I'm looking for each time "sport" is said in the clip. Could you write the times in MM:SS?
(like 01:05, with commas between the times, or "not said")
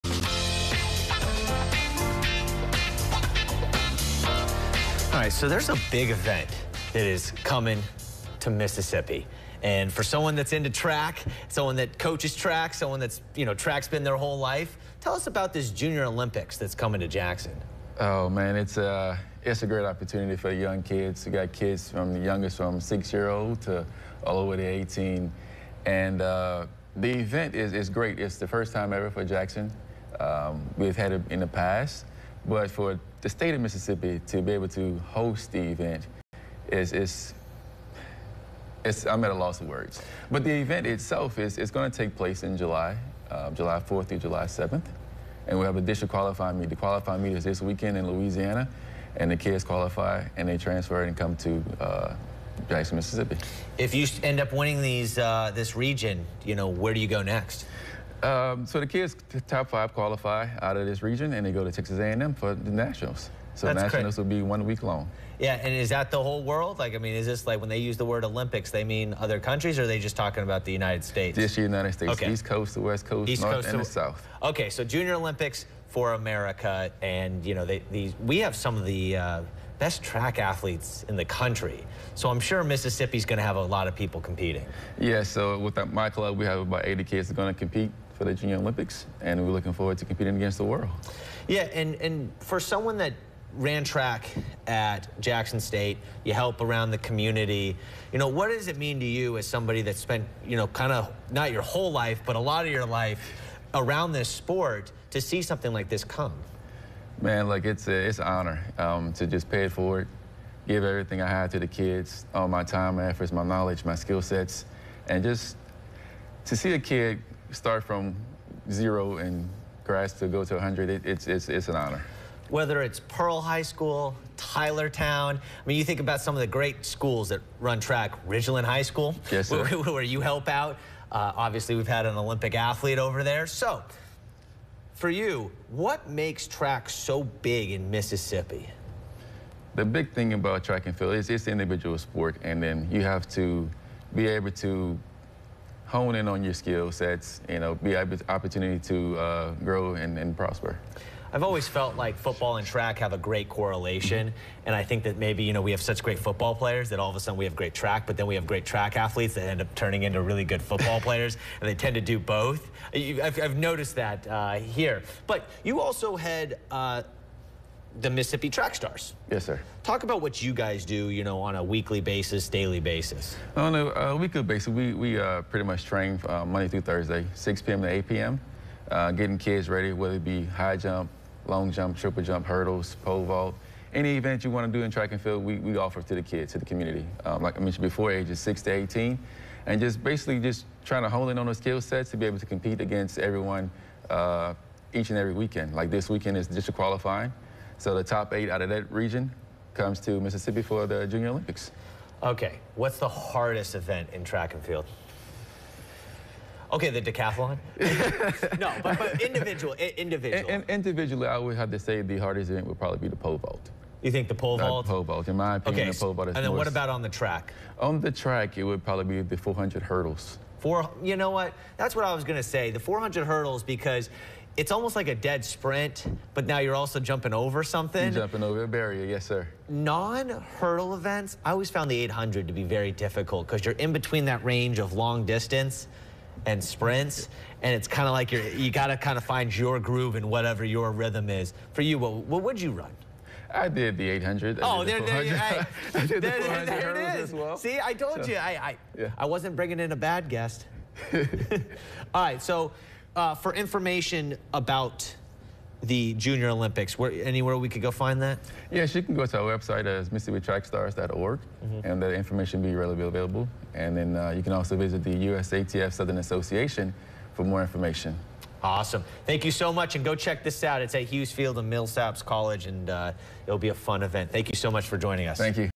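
01:44, 02:21.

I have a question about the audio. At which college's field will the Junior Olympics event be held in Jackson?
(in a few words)
Millsaps College.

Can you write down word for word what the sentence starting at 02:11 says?
Uh, obviously, we've had an Olympic athlete over there.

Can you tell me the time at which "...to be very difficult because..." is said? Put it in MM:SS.
03:52.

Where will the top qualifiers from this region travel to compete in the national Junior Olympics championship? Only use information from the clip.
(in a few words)
Texas A&M.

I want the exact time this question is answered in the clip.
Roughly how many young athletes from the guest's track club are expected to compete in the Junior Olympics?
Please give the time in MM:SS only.
01:26.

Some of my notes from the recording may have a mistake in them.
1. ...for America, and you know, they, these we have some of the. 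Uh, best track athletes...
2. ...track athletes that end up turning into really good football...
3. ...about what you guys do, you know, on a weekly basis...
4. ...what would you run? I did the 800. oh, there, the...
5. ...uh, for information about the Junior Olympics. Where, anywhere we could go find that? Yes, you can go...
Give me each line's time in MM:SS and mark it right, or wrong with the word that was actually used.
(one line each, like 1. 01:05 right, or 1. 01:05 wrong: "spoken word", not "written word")
1. 01:15 right
2. 02:38 right
3. 02:50 right
4. 04:02 right
5. 04:13 right.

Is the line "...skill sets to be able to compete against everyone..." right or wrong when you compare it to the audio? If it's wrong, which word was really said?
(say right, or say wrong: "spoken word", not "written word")
right.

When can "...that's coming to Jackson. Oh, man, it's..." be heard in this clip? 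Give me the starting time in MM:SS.
00:16.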